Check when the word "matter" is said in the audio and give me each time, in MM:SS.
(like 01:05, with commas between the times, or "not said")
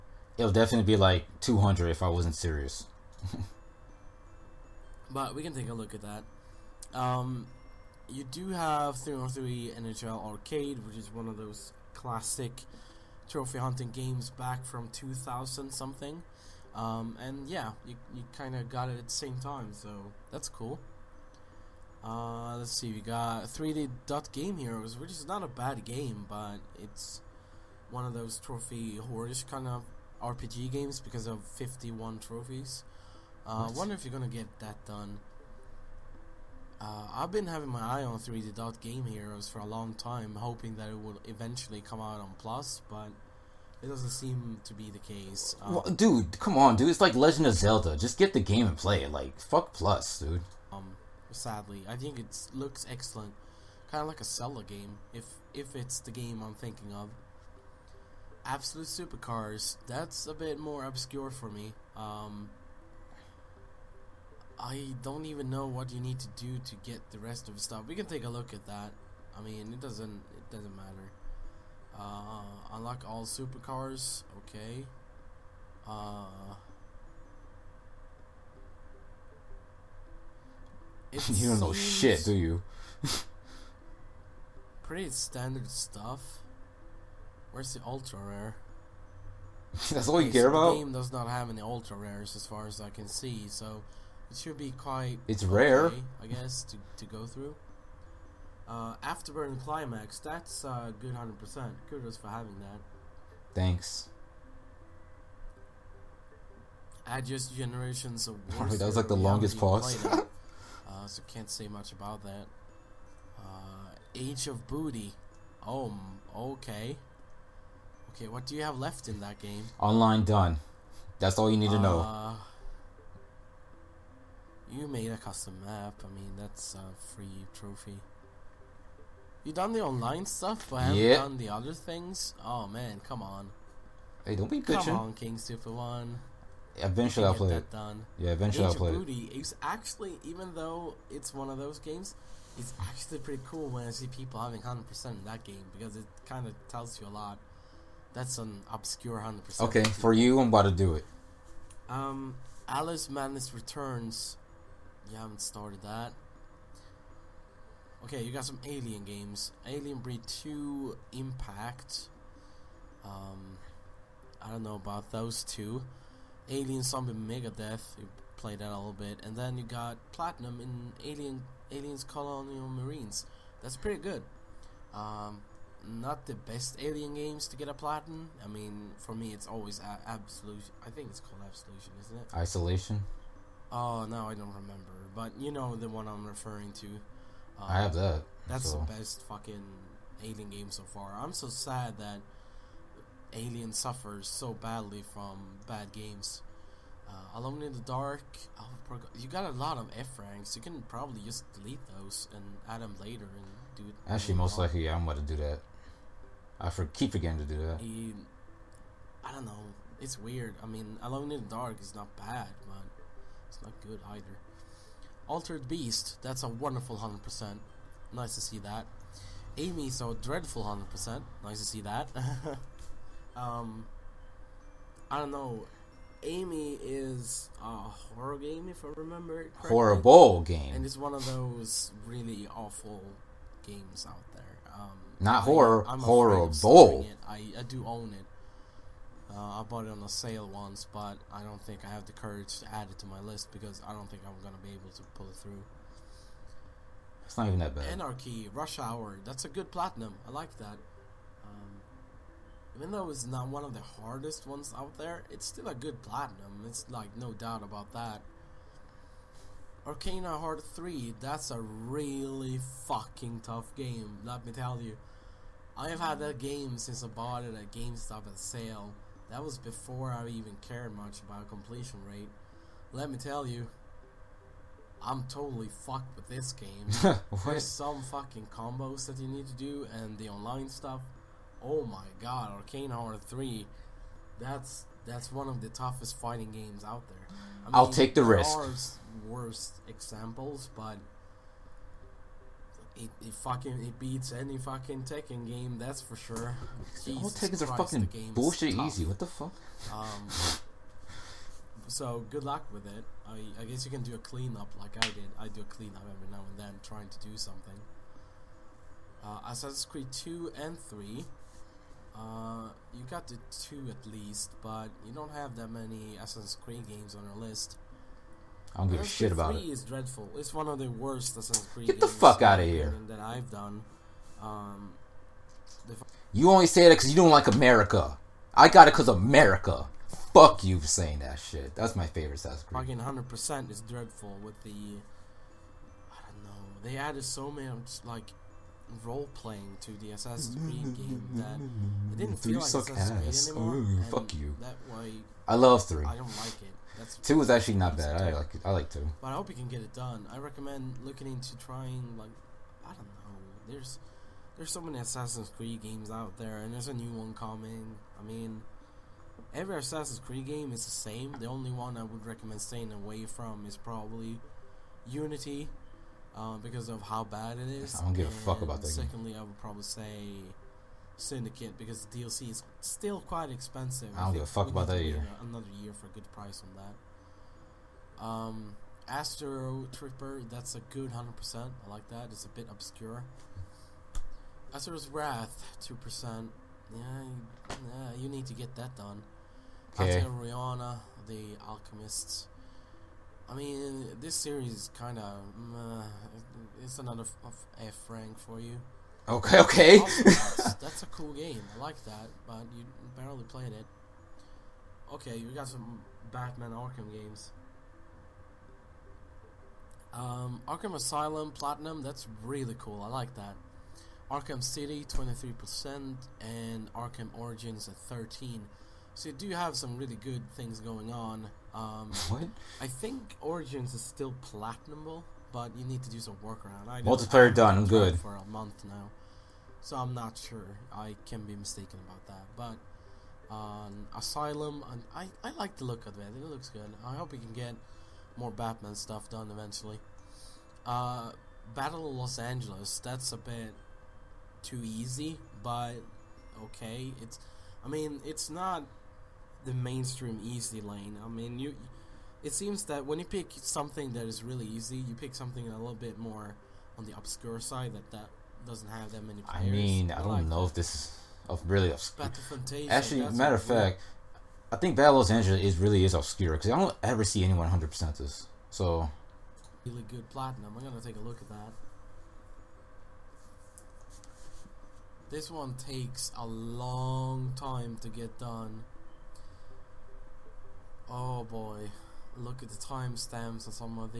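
01:10, 07:43.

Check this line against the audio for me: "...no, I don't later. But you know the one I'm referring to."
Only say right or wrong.
wrong.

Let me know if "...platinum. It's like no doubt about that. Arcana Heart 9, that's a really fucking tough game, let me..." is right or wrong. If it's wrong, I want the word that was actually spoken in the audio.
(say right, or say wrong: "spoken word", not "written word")
wrong: "3", not "9".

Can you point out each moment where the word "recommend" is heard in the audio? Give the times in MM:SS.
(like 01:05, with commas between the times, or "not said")
05:50, 06:02.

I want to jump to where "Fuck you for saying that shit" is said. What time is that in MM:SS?
05:30.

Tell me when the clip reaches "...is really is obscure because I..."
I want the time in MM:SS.
07:45.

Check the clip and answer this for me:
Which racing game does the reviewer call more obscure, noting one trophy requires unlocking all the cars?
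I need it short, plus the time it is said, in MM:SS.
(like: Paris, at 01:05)
Absolute Supercars, at 00:58.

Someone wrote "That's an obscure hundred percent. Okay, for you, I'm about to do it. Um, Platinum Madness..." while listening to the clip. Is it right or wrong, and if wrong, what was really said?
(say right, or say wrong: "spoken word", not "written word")
wrong: "Alice", not "Platinum".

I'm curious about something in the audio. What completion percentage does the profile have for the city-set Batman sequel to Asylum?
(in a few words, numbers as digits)
23%.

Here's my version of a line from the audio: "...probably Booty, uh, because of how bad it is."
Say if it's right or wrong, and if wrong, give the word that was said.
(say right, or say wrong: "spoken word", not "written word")
wrong: "Unity", not "Booty".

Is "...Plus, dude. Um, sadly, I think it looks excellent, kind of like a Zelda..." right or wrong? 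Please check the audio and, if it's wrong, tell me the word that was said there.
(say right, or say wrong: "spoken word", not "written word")
right.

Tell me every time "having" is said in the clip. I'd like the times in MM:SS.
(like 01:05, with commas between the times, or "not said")
00:37, 01:42, 02:24.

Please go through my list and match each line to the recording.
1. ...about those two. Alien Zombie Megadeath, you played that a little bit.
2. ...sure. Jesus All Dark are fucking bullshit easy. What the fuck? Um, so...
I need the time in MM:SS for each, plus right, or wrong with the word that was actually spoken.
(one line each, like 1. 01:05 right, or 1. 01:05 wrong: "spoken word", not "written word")
1. 02:44 right
2. 04:56 wrong: "Tekkens", not "Dark".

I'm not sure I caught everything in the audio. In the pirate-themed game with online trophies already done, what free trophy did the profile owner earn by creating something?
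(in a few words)
a custom map.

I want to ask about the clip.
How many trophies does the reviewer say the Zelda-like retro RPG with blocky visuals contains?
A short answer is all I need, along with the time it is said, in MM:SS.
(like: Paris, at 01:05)
51, at 00:31.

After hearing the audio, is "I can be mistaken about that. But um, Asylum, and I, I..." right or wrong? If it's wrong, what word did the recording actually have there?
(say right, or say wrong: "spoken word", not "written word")
right.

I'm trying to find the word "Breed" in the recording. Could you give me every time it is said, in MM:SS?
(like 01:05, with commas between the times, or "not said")
02:39.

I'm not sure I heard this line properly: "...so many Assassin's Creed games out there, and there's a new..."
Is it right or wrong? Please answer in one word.
right.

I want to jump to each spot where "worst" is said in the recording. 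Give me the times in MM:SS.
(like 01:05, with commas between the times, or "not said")
04:49, 05:20.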